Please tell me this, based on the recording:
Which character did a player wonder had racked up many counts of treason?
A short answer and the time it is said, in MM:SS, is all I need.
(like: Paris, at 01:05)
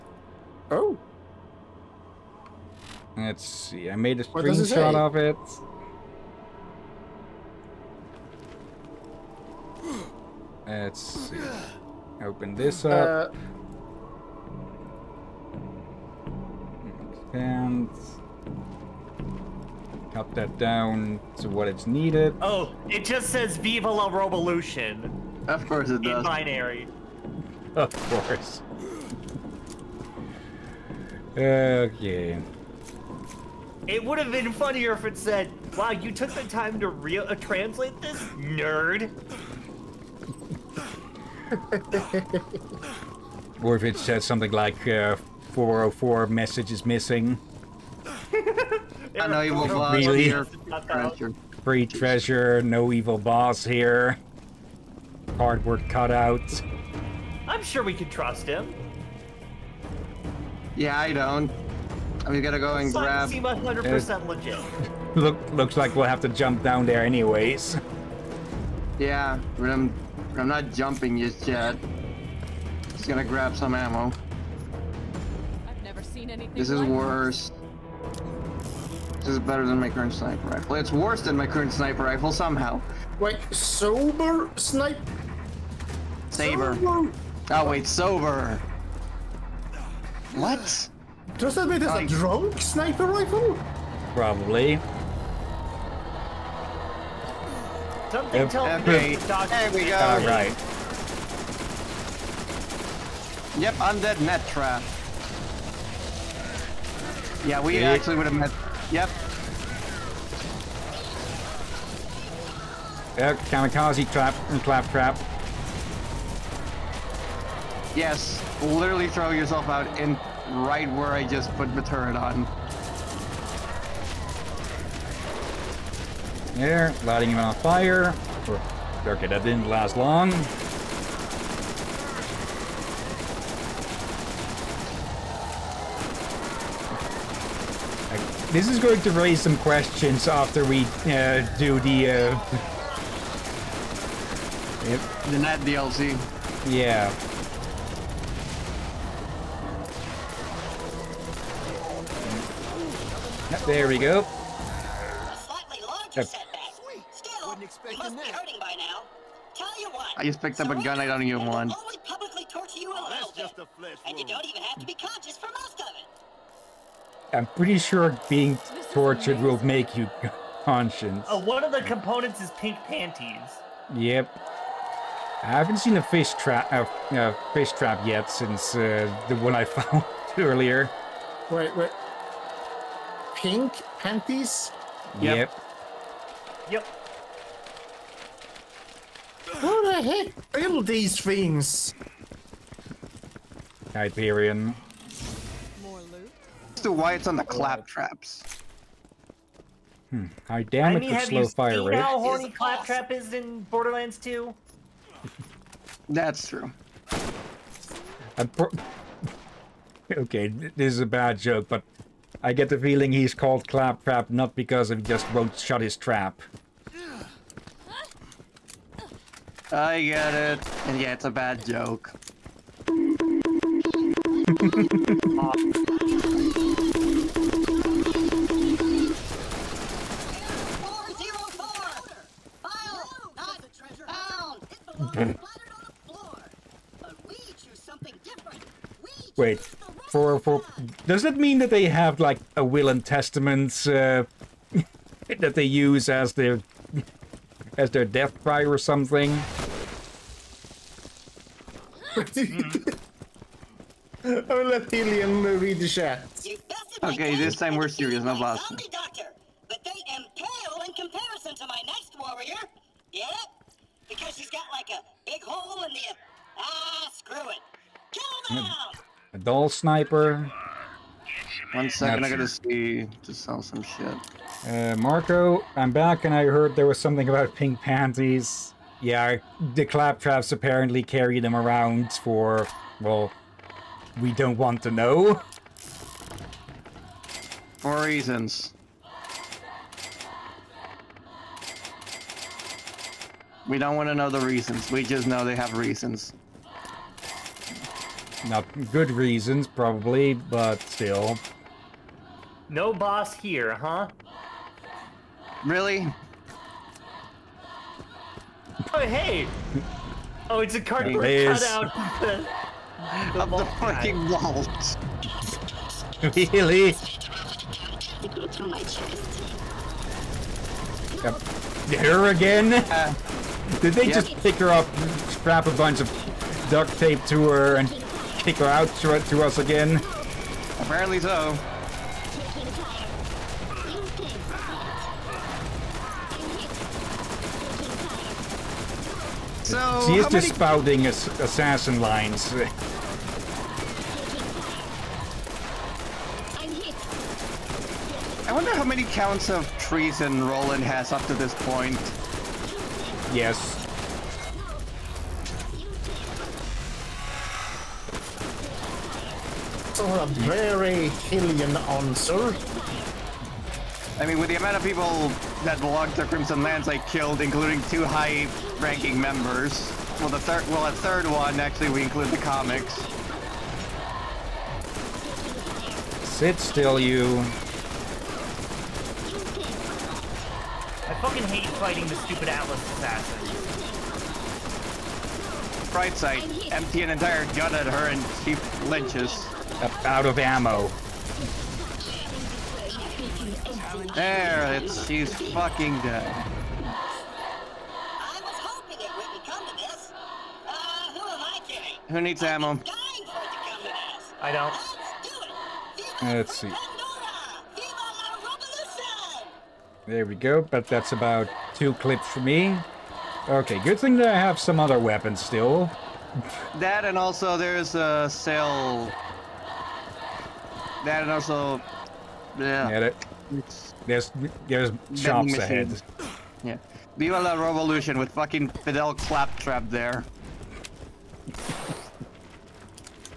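Roland, at 05:50.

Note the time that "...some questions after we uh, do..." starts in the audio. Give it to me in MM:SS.
02:19.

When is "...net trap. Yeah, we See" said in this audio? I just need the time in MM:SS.
01:44.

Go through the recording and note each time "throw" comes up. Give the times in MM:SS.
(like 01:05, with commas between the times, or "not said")
01:59.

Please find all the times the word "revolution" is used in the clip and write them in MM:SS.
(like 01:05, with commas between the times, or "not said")
00:24, 07:07.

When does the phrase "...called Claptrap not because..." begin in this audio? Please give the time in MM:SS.
03:33.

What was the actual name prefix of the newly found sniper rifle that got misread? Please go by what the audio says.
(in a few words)
Saber.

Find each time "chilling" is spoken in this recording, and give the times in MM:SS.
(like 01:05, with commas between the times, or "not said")
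06:01.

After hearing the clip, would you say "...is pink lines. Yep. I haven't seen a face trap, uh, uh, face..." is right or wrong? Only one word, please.
wrong.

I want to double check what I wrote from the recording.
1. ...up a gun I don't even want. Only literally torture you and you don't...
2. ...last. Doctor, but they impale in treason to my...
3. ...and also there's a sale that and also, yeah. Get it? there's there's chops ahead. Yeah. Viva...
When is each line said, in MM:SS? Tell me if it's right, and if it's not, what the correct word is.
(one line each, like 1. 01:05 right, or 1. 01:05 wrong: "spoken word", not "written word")
1. 02:40 wrong: "publicly", not "literally"
2. 04:18 wrong: "comparison", not "treason"
3. 06:57 right.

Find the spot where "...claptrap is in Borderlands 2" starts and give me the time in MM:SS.
03:22.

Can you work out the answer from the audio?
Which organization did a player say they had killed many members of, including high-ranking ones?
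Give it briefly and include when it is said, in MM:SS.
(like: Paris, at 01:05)
Crimson Lance, at 06:06.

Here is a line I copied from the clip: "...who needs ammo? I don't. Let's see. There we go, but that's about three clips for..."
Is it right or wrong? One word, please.
wrong.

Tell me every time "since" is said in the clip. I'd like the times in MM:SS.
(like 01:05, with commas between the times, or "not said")
02:58.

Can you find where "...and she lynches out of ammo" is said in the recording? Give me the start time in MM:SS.
06:28.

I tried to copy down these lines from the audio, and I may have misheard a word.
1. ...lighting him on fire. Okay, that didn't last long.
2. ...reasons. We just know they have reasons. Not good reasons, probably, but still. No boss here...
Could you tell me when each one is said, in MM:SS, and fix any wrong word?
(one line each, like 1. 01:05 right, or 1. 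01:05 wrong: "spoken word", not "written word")
1. 02:07 right
2. 04:54 right.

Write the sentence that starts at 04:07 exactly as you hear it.
as their death cry or something?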